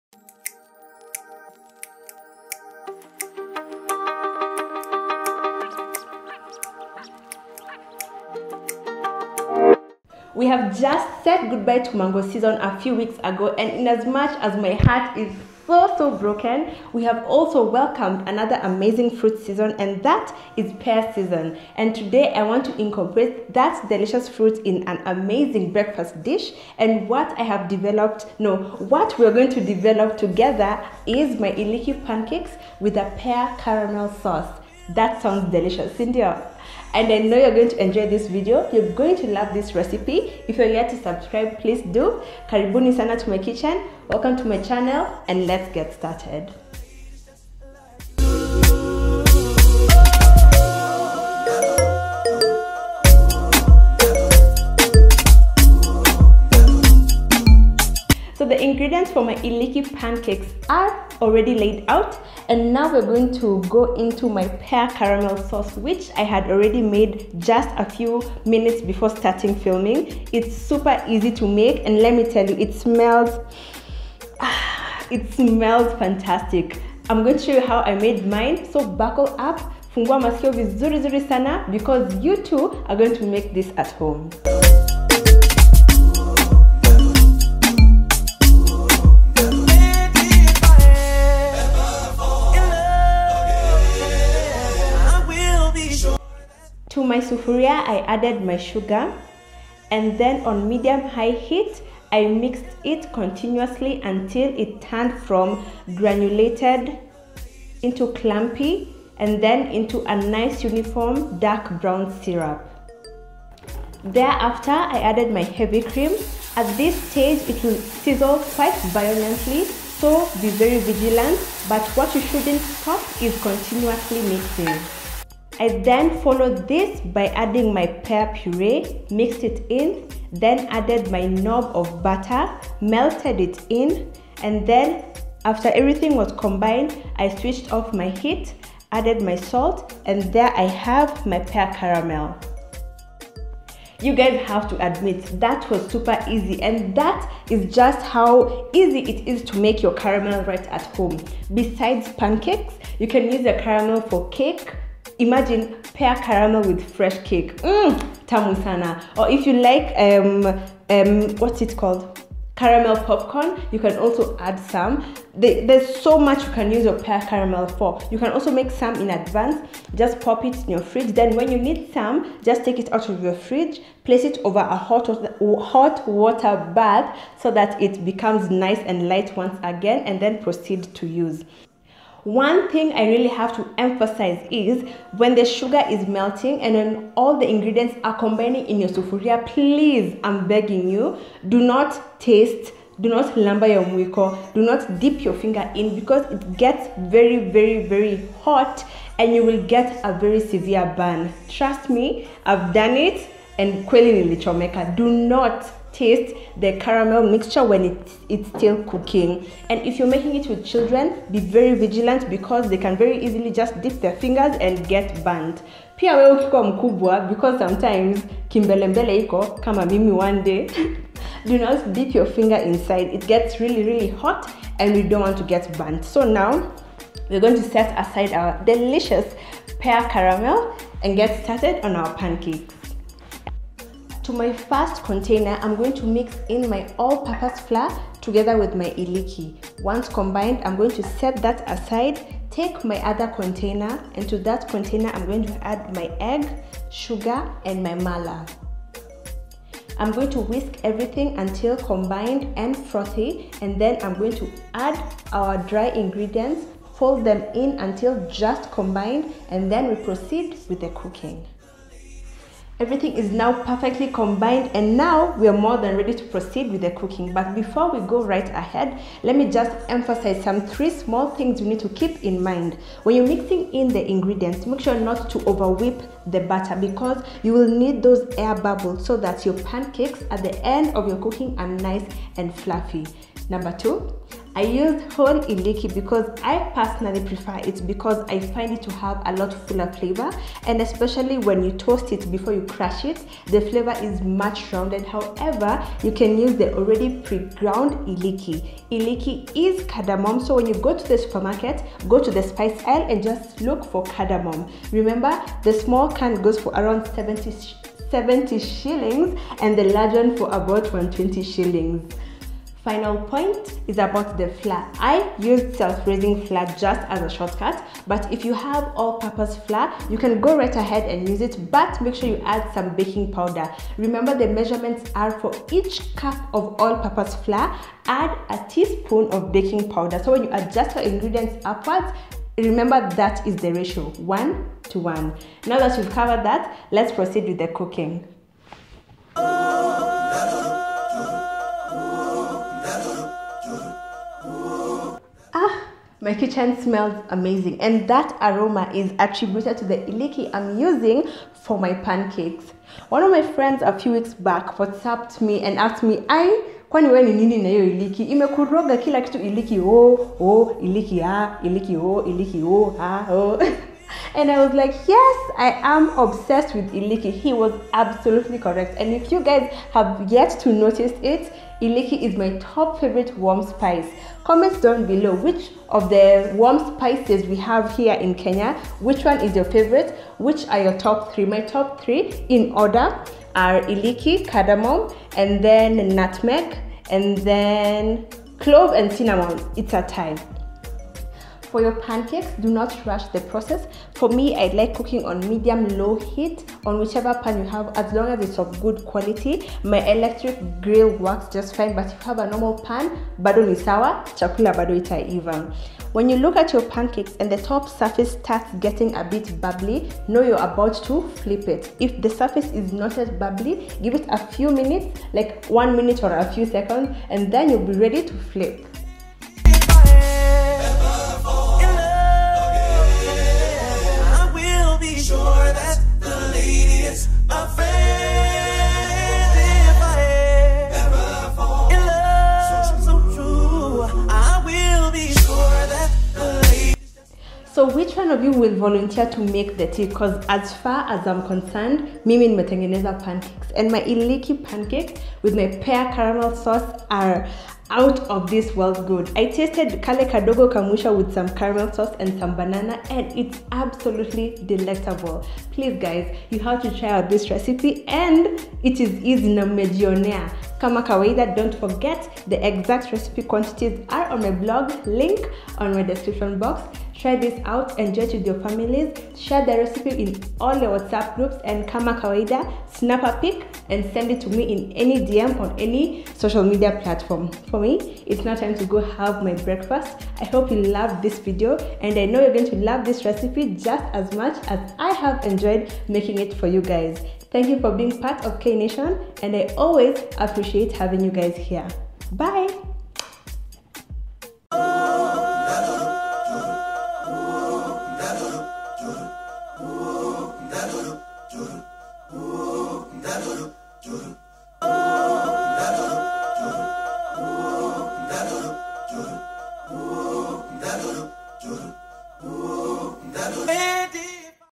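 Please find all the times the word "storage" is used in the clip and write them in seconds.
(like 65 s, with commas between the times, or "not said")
not said.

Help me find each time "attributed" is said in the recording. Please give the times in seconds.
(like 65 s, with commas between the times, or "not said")
349 s.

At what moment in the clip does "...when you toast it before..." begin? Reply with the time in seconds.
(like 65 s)
291 s.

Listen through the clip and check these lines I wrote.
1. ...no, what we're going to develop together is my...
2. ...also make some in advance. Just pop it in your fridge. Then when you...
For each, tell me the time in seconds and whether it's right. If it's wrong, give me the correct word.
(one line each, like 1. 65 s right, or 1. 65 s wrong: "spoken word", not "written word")
1. 28 s right
2. 168 s right.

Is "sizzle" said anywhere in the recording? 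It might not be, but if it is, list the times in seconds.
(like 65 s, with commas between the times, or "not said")
118 s.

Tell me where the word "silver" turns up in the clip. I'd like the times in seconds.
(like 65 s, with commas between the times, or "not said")
not said.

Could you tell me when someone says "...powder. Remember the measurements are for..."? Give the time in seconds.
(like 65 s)
323 s.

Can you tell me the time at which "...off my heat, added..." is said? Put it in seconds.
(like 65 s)
137 s.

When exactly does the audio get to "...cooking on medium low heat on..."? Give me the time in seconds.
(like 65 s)
394 s.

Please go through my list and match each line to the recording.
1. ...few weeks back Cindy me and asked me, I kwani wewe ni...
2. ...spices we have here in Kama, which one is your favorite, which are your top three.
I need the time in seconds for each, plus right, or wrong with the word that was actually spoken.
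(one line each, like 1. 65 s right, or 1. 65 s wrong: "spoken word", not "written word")
1. 353 s wrong: "WhatsApped", not "Cindy"
2. 376 s wrong: "Kenya", not "Kama".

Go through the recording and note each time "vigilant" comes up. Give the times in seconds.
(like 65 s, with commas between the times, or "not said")
120 s, 211 s.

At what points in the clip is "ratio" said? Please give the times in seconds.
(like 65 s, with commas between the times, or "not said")
333 s.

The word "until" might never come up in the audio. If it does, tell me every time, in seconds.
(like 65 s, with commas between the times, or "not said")
104 s, 251 s, 257 s.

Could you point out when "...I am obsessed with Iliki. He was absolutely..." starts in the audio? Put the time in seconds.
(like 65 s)
365 s.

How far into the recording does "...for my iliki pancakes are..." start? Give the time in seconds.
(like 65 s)
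59 s.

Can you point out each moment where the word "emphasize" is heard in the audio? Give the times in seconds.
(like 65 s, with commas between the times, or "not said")
183 s, 269 s.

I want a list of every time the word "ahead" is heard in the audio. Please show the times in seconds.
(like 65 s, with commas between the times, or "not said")
268 s, 320 s.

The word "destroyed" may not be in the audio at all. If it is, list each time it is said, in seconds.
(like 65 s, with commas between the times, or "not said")
not said.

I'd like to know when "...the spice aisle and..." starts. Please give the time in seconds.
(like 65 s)
302 s.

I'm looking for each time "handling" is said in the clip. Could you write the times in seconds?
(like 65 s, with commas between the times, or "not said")
not said.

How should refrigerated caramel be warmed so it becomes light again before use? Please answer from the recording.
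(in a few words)
Hot water bath.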